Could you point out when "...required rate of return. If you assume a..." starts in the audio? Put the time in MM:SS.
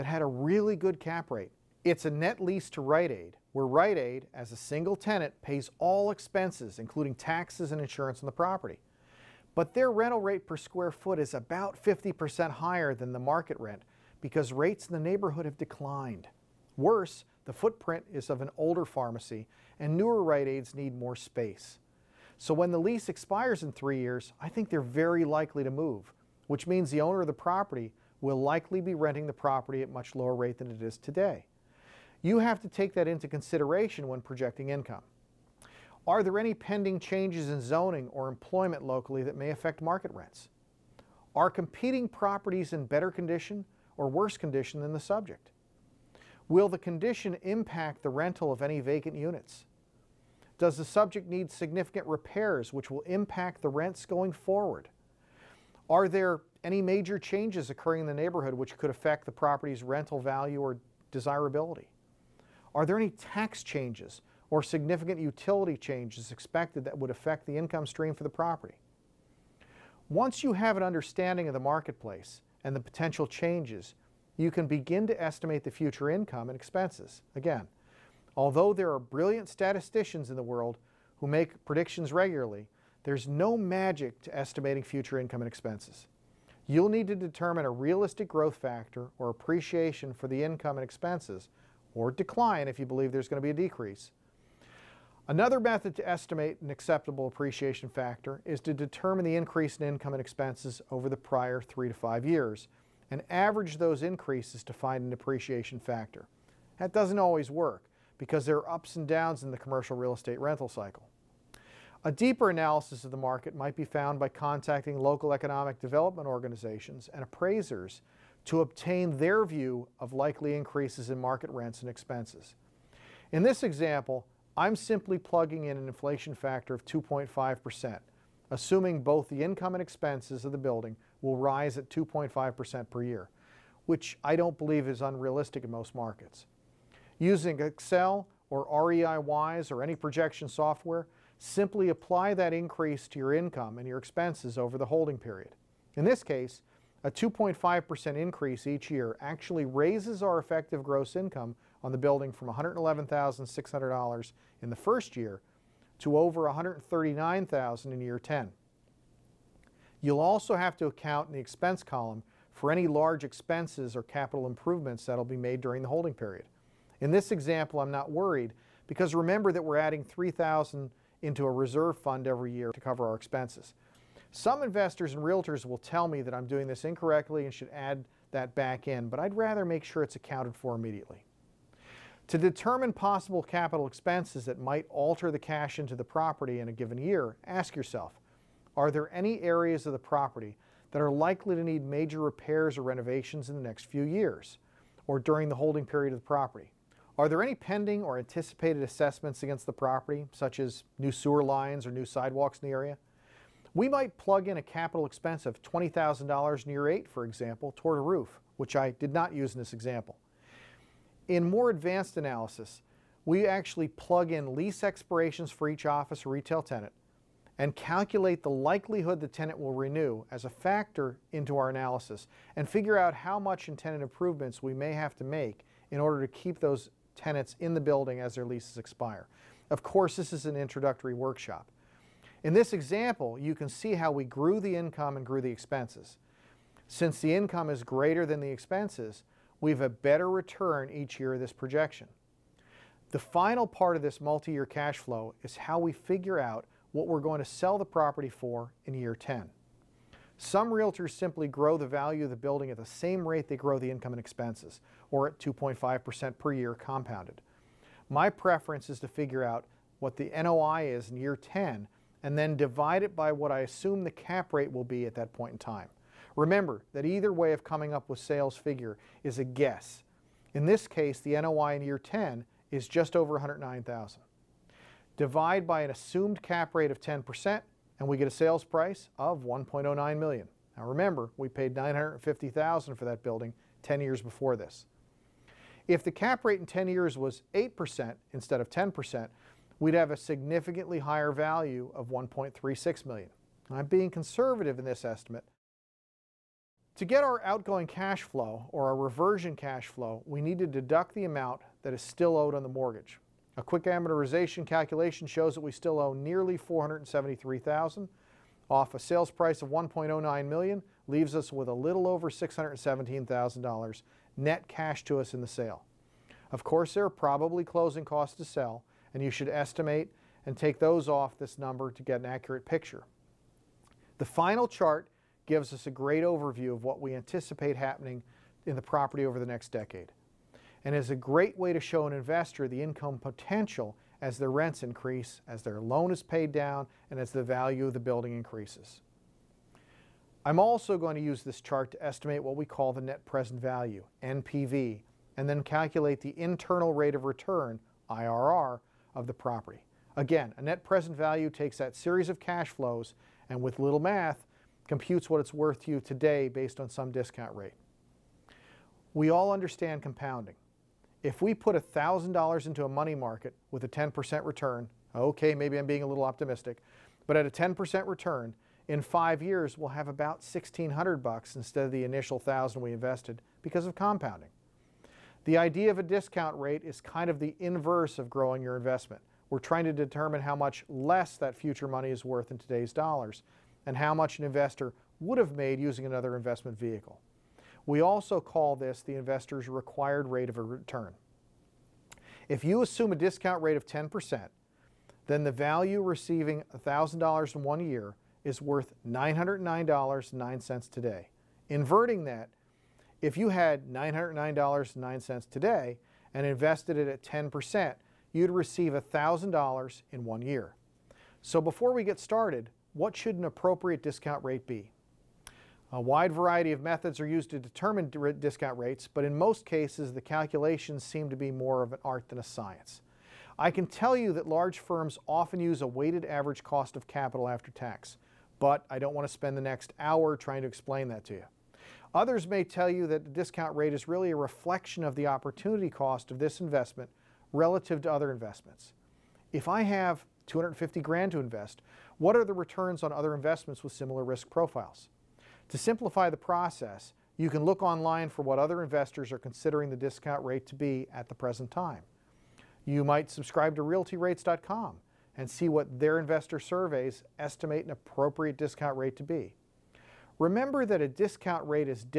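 06:29.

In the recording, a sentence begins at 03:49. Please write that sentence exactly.
Of course, this is an introductory workshop.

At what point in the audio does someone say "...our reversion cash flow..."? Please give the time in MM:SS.
04:58.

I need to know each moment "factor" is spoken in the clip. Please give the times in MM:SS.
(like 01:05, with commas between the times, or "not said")
01:28, 01:37, 01:45, 02:06, 03:40.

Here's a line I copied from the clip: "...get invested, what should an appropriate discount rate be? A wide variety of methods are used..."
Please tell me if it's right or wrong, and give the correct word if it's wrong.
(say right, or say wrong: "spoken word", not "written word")
wrong: "started", not "invested".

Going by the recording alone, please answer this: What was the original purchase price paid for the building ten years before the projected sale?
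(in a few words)
950,000.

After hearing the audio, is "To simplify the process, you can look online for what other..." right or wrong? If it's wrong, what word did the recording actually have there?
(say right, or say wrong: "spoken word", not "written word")
right.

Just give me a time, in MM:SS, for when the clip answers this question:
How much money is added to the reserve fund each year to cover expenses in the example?
02:50.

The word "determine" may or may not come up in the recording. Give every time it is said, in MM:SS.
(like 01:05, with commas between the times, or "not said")
01:27, 01:38, 03:02, 06:19, 06:57.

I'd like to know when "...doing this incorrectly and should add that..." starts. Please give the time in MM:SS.
02:56.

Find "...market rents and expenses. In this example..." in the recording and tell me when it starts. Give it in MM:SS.
02:01.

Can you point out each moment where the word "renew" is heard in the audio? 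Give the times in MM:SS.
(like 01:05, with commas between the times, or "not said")
03:39.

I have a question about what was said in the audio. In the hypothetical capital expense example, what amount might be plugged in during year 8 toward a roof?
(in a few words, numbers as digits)
$20,000.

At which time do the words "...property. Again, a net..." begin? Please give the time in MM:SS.
05:49.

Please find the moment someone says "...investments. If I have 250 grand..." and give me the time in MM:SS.
07:18.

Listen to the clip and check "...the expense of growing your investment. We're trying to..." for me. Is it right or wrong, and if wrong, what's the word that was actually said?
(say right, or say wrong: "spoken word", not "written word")
wrong: "inverse", not "expense".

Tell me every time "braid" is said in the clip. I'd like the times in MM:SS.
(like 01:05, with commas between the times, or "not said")
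not said.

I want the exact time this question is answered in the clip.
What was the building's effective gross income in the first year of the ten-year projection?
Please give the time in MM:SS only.
02:32.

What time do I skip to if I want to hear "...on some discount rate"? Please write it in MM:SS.
05:56.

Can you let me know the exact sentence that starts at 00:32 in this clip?
You have to take that into consideration when projecting income.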